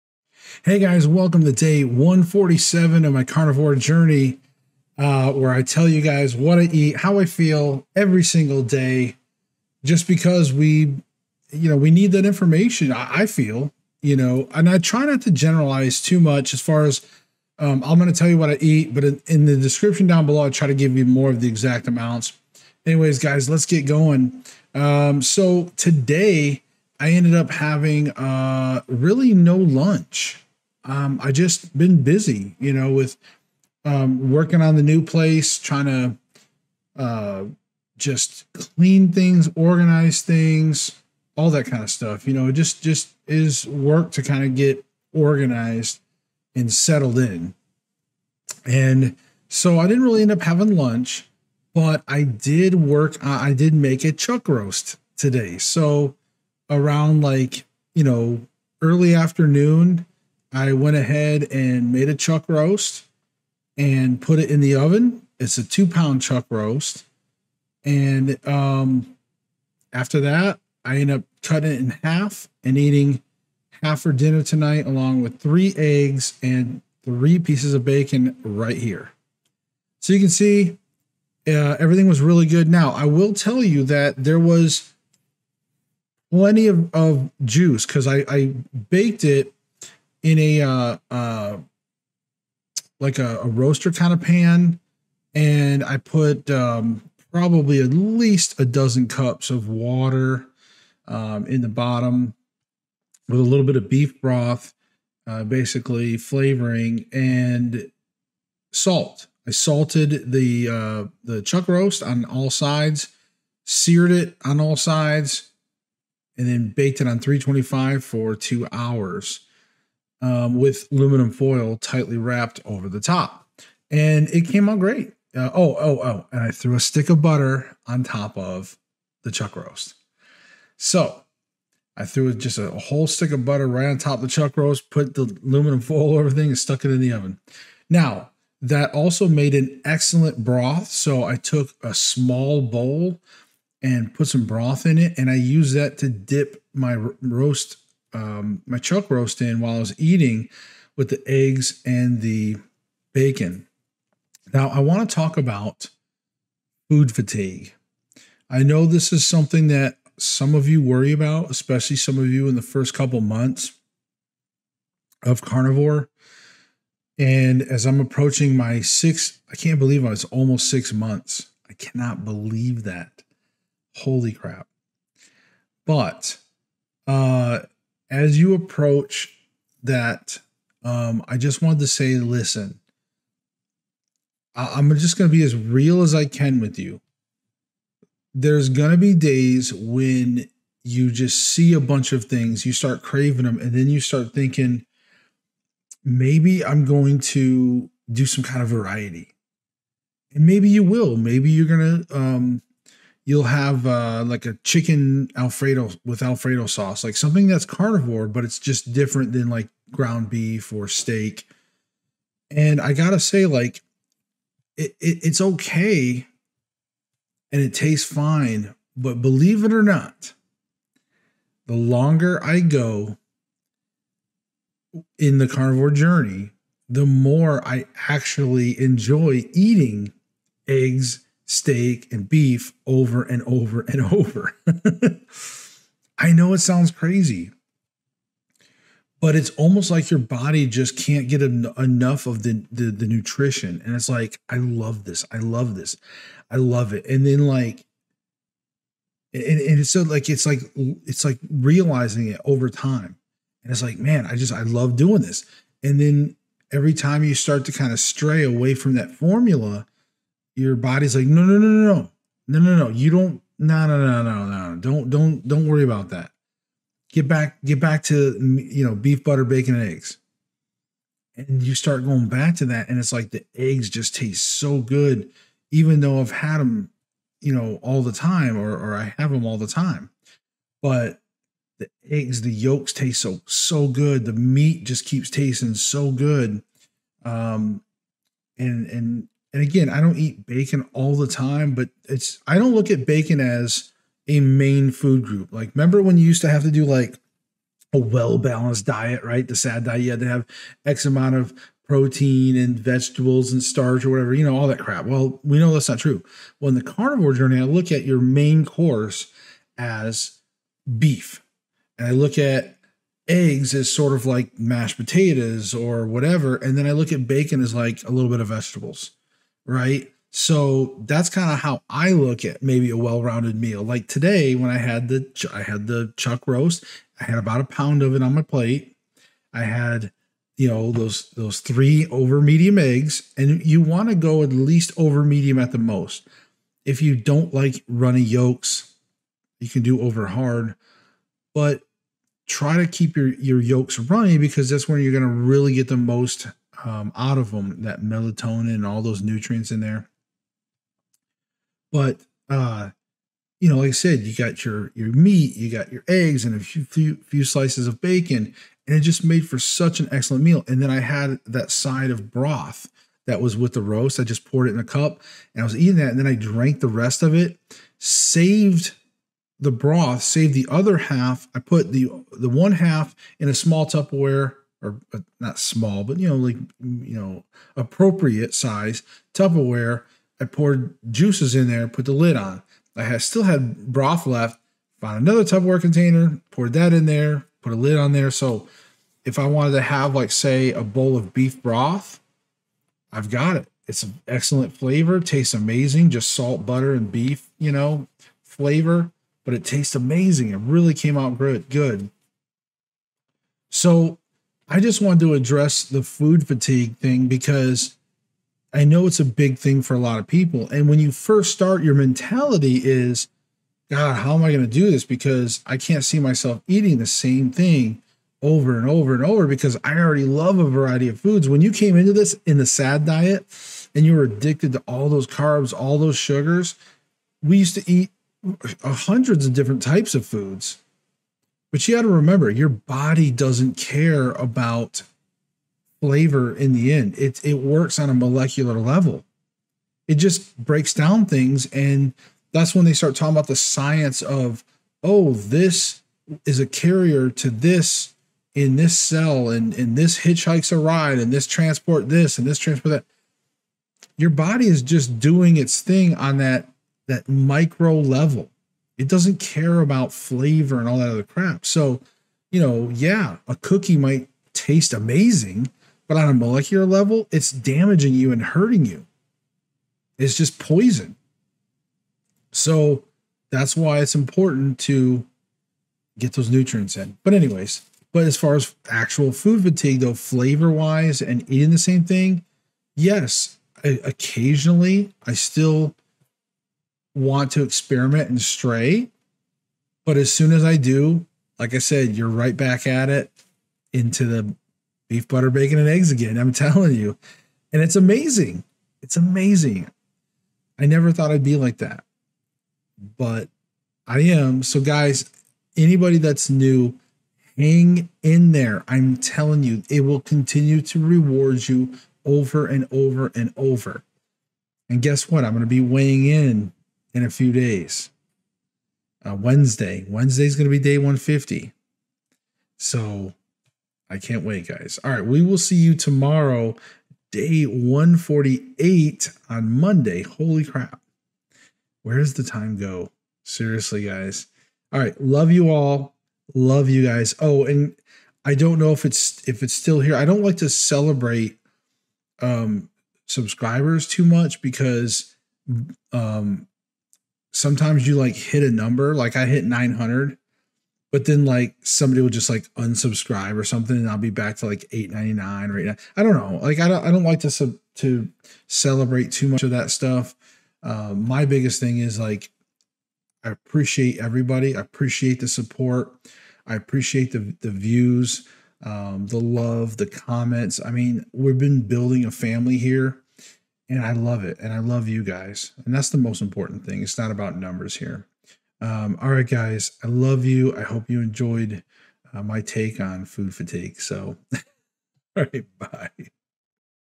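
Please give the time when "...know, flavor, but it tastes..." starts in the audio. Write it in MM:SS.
06:37.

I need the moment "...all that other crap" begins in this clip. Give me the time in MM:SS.
07:40.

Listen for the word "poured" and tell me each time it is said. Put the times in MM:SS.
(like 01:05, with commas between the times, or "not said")
06:04, 06:20, 06:26.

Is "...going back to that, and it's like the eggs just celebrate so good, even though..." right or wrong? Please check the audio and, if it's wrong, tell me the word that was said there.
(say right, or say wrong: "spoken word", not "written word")
wrong: "taste", not "celebrate".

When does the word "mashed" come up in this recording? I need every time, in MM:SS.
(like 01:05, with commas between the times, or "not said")
05:14.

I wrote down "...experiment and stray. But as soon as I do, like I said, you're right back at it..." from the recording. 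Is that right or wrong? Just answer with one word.
right.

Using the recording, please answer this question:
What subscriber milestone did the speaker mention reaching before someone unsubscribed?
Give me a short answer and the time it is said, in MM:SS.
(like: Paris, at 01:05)
900, at 09:09.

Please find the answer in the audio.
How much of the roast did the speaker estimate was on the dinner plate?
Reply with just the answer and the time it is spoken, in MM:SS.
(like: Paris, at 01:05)
about a pound, at 05:27.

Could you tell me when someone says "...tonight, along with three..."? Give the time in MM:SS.
01:14.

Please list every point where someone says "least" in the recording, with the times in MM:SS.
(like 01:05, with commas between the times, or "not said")
01:37, 05:34.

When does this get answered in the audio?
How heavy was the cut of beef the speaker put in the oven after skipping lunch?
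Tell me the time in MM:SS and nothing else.
01:05.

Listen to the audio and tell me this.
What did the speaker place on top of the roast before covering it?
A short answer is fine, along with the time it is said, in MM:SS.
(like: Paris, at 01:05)
a stick of butter, at 02:12.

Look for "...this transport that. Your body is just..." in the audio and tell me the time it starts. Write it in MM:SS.
07:32.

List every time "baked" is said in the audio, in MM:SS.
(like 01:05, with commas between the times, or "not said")
01:28, 01:56.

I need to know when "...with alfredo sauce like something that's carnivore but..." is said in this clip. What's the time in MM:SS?
03:26.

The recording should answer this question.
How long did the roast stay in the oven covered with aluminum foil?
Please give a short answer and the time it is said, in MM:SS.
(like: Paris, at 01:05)
2 hours, at 01:58.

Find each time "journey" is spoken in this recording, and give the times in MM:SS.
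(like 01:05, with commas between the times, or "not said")
00:03, 03:45, 05:07.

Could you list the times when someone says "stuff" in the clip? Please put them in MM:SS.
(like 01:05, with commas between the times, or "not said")
00:41, 09:19.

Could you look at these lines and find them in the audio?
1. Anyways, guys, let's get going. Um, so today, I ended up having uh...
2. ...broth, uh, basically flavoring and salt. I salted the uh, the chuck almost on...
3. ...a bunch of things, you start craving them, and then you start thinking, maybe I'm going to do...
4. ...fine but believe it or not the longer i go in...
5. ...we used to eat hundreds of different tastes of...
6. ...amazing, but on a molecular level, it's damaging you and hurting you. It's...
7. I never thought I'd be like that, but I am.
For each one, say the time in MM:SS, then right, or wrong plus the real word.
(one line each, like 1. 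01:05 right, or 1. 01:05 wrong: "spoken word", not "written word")
1. 00:22 right
2. 01:44 wrong: "roast", not "almost"
3. 03:11 right
4. 03:38 right
5. 07:07 wrong: "types", not "tastes"
6. 07:44 right
7. 08:20 right.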